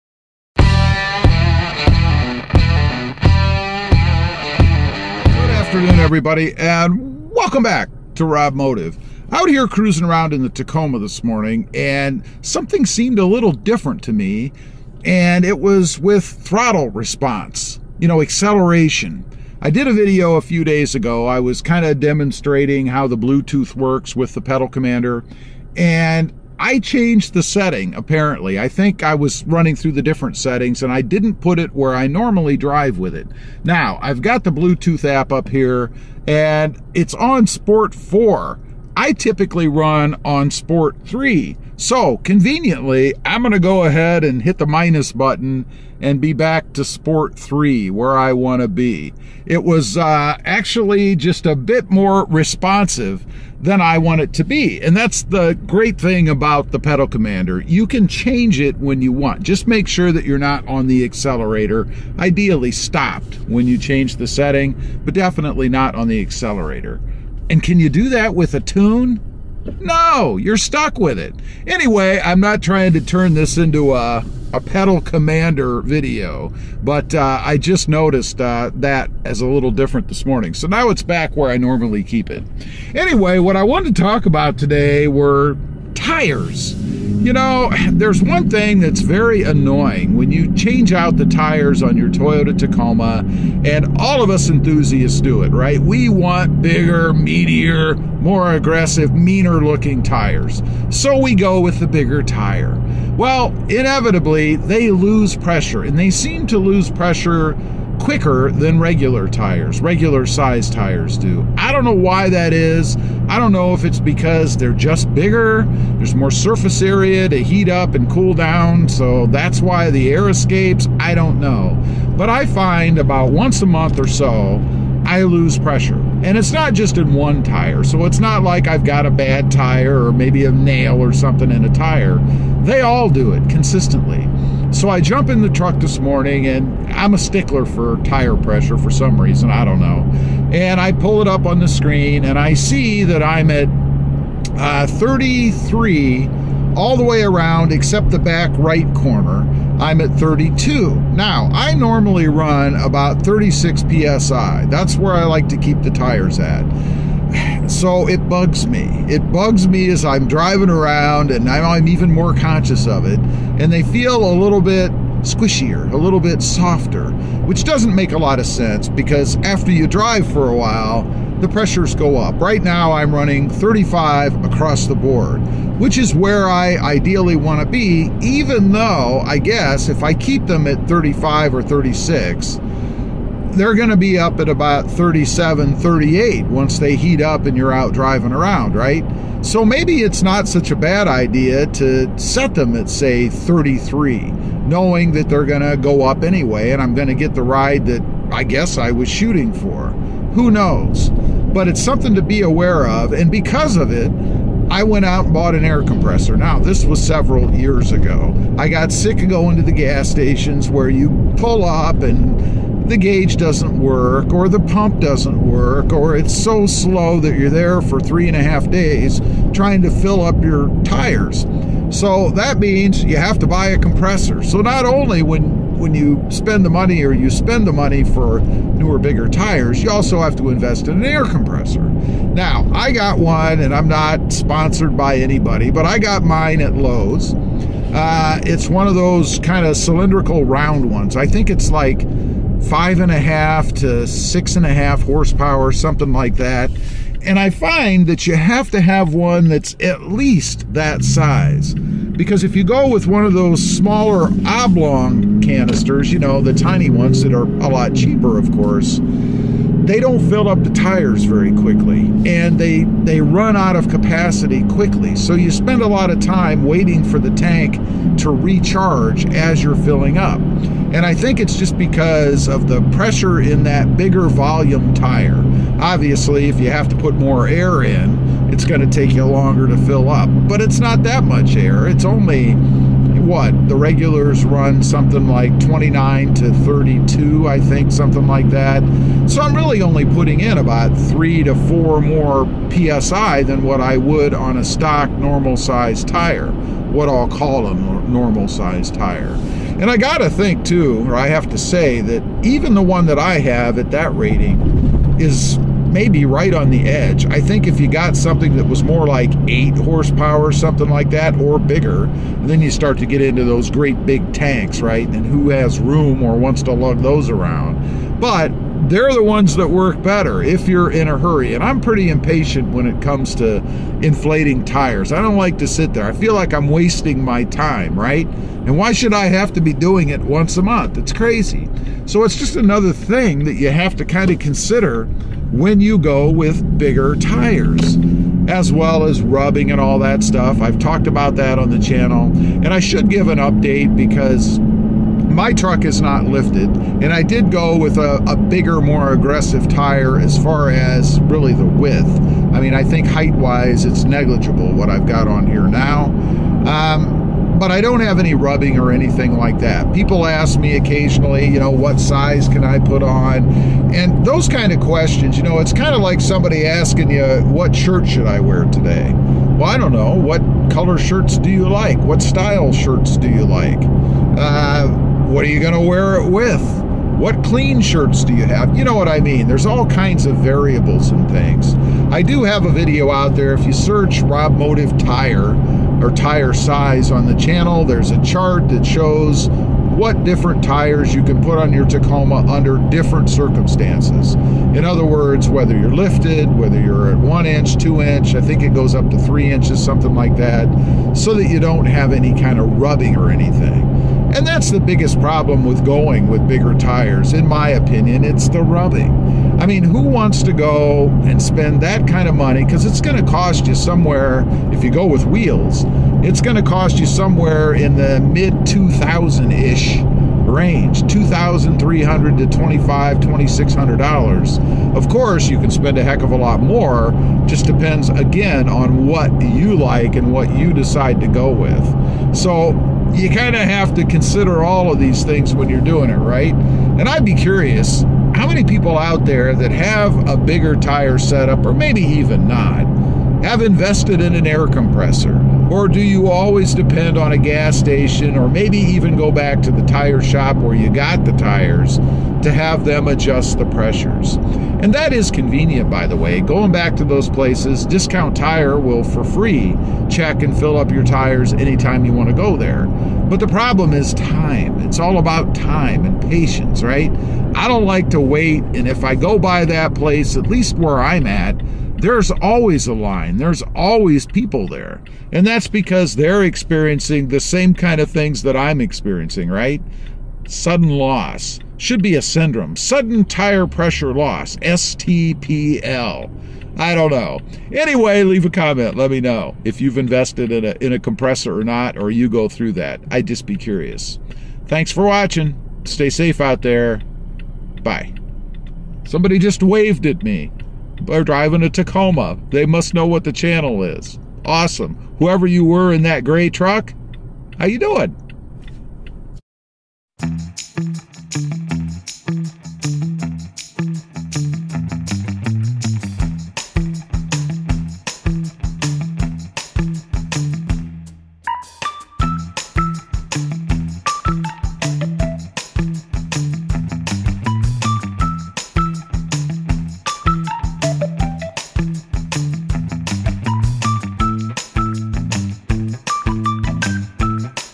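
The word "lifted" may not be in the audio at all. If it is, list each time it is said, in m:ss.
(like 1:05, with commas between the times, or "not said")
5:46, 6:35.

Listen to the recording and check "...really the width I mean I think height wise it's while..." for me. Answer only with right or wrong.
wrong.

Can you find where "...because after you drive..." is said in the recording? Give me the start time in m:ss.
2:48.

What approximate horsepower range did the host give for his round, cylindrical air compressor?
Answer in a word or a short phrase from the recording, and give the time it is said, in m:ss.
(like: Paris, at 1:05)
5.5 to 6.5 horsepower, at 4:02.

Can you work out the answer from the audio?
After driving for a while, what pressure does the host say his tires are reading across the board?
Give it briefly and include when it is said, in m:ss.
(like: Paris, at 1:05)
35, at 2:53.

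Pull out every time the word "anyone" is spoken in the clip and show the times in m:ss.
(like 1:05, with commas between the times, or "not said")
not said.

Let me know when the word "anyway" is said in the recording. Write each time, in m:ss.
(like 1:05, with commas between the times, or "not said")
1:11, 1:22, 3:16, 8:07.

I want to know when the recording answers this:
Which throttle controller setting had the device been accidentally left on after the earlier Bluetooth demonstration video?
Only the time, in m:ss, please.
0:37.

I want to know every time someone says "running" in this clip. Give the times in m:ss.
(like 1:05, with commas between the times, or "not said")
0:29, 2:53.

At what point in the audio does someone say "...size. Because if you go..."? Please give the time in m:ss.
4:11.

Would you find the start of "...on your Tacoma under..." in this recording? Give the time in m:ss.
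6:31.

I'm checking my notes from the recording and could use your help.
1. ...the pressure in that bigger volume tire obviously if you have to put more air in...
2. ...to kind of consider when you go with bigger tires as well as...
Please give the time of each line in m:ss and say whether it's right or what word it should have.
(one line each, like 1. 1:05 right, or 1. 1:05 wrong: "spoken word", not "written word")
1. 4:32 right
2. 5:33 right.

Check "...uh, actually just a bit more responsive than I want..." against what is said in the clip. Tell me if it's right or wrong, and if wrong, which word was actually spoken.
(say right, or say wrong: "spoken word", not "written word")
right.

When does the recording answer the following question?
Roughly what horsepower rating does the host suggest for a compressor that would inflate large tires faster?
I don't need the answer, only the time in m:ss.
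5:09.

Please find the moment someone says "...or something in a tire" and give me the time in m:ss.
2:10.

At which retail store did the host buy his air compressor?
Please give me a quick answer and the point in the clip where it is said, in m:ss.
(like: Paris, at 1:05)
Lowe's, at 3:56.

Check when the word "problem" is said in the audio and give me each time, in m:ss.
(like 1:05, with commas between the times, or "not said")
6:45, 7:43.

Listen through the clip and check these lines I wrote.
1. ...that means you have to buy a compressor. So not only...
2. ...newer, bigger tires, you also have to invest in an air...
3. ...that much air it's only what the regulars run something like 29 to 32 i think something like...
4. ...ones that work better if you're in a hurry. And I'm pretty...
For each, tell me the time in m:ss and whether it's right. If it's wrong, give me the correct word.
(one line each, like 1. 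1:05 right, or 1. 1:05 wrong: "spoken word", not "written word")
1. 3:42 right
2. 3:48 right
3. 4:41 right
4. 5:19 right.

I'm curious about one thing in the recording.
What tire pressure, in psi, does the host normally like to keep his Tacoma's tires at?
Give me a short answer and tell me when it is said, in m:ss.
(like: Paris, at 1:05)
36, at 2:33.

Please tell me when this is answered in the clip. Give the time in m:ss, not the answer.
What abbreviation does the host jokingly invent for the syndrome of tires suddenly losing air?
8:04.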